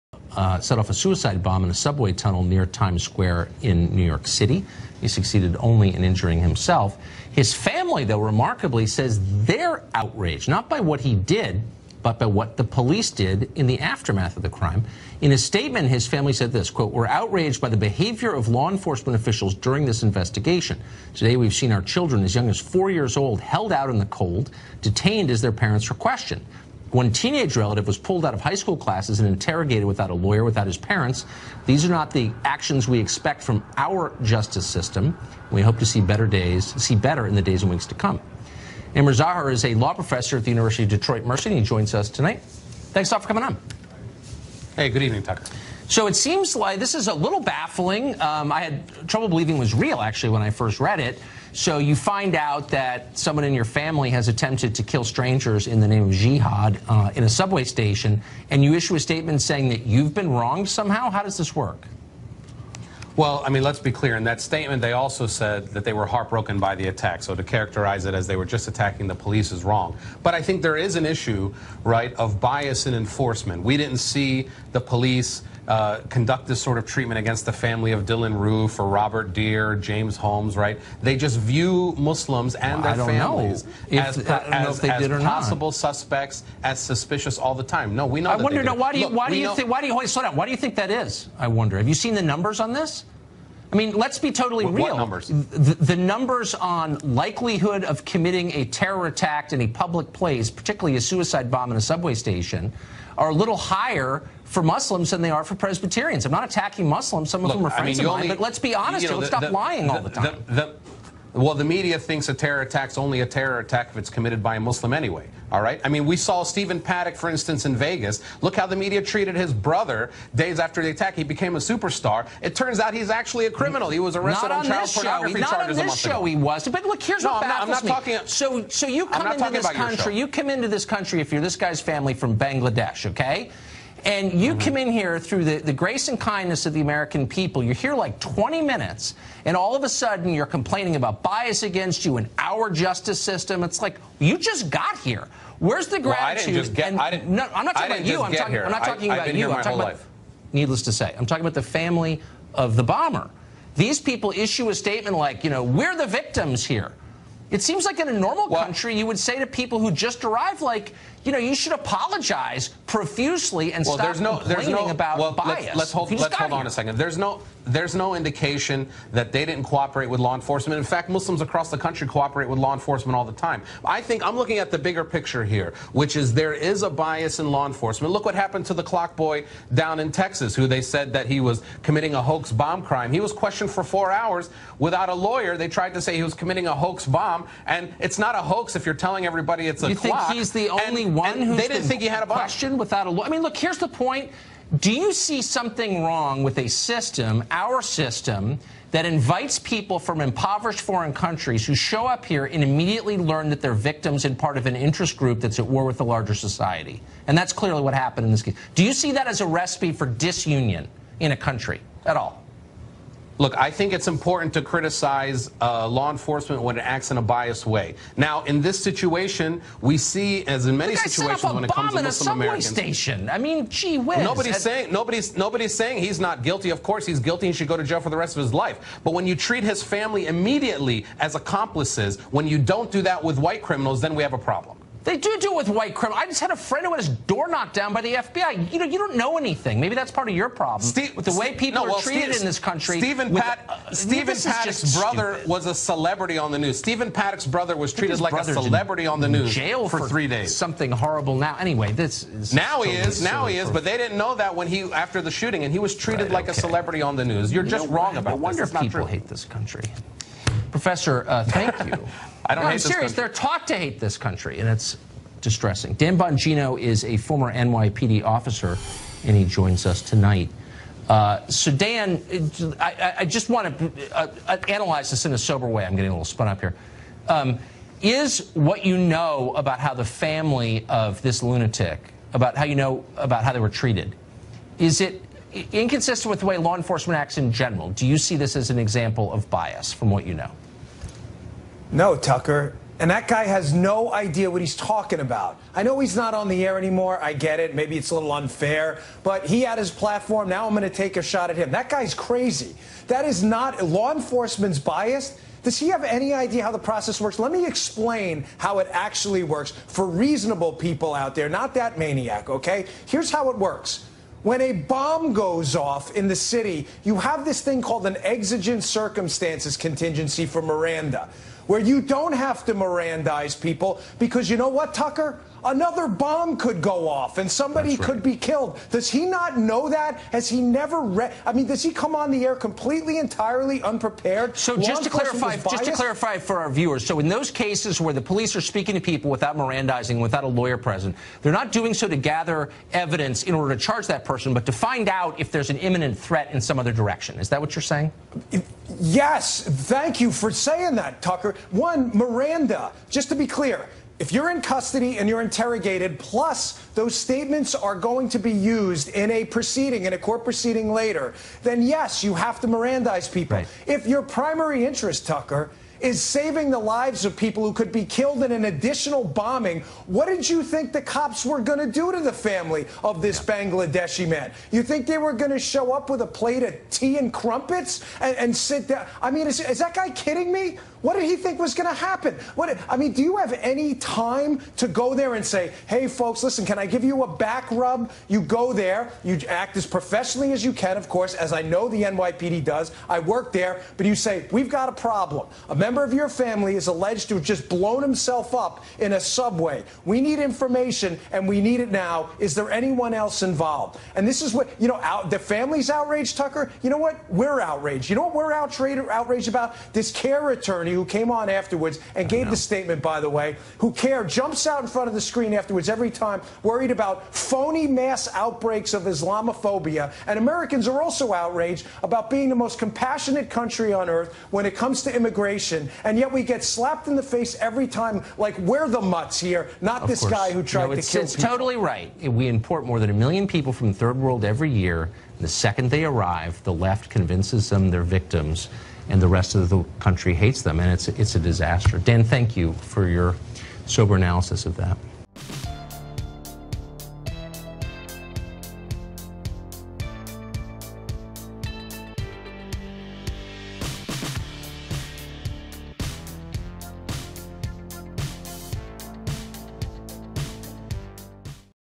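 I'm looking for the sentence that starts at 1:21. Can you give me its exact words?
They just view Muslims and well, their families as, if, as, as, as possible suspects, as suspicious all the time.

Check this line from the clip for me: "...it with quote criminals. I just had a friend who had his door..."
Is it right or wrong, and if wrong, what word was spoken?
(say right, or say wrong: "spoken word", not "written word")
wrong: "white", not "quote".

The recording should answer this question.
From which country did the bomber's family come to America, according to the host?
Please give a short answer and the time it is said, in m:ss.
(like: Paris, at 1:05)
Bangladesh, at 2:12.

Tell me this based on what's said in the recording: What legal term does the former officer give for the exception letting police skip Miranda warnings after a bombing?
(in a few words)
exigent circumstances.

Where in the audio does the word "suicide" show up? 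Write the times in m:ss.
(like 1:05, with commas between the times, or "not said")
0:00, 1:41.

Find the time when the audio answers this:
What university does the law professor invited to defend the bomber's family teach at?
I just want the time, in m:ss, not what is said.
0:40.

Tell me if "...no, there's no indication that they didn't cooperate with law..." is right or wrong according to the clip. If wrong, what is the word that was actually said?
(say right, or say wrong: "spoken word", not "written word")
right.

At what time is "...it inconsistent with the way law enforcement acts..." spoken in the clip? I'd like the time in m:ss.
4:45.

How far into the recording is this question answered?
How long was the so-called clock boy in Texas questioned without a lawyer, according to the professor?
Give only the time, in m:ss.
3:03.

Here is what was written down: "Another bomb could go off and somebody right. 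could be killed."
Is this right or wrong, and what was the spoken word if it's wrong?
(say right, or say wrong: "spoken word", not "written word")
right.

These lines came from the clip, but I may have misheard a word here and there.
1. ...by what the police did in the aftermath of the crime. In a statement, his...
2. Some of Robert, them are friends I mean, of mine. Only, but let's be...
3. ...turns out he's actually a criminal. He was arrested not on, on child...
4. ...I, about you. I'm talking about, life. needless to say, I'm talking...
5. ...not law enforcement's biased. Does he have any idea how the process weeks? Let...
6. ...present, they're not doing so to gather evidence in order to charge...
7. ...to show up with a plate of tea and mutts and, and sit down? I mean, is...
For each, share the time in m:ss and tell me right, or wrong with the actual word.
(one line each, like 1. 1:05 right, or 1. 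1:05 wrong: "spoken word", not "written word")
1. 0:12 right
2. 1:47 wrong: "Look", not "Robert"
3. 2:02 right
4. 2:29 right
5. 5:03 wrong: "works", not "weeks"
6. 5:40 right
7. 6:15 wrong: "crumpets", not "mutts".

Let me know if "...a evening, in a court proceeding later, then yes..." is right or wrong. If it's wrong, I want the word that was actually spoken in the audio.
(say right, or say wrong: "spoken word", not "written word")
wrong: "proceeding", not "evening".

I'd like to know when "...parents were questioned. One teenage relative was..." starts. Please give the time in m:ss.
0:25.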